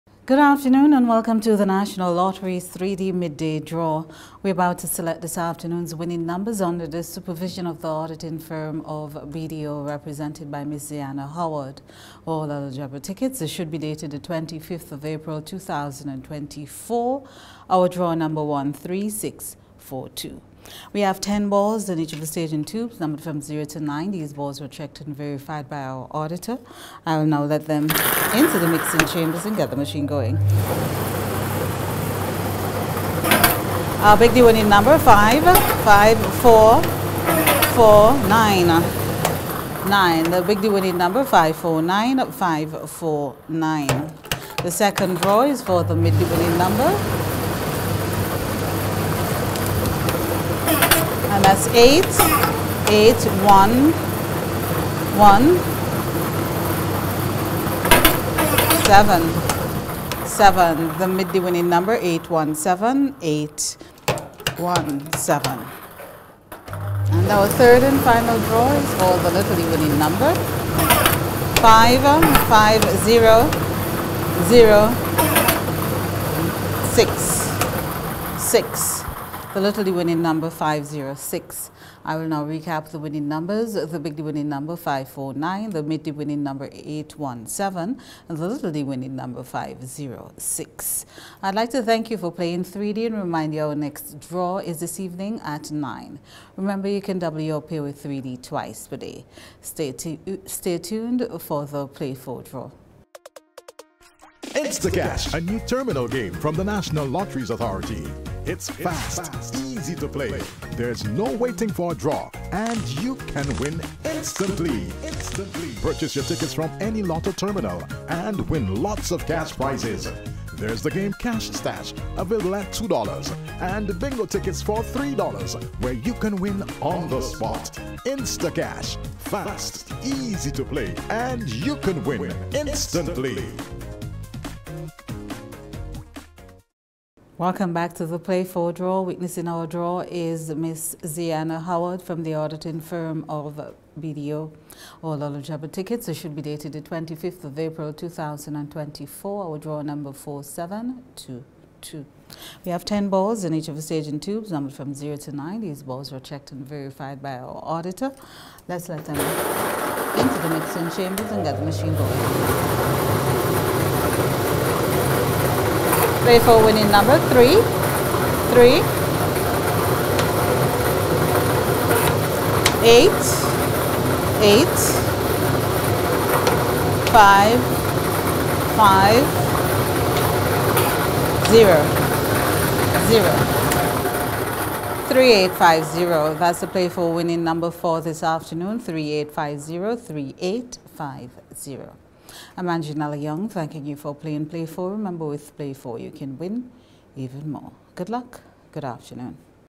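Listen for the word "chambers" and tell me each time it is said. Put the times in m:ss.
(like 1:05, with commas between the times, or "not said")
0:29, 2:41.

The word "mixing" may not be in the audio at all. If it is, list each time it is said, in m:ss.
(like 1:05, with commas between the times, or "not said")
0:28, 2:40.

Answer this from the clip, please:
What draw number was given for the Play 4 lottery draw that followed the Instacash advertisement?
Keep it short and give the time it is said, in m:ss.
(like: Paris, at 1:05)
4722, at 2:30.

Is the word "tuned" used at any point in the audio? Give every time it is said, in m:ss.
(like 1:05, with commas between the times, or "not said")
1:40.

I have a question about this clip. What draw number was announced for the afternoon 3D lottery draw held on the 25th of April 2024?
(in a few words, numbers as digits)
13642.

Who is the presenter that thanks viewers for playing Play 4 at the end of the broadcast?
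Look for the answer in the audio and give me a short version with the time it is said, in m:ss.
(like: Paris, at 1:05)
Angela Young, at 3:12.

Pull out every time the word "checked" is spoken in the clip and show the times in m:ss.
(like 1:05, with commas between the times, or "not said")
0:24, 2:36.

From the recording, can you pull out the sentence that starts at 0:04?
We're about to select this afternoon's winning numbers under the supervision of the auditing firm of BDO represented by Ms.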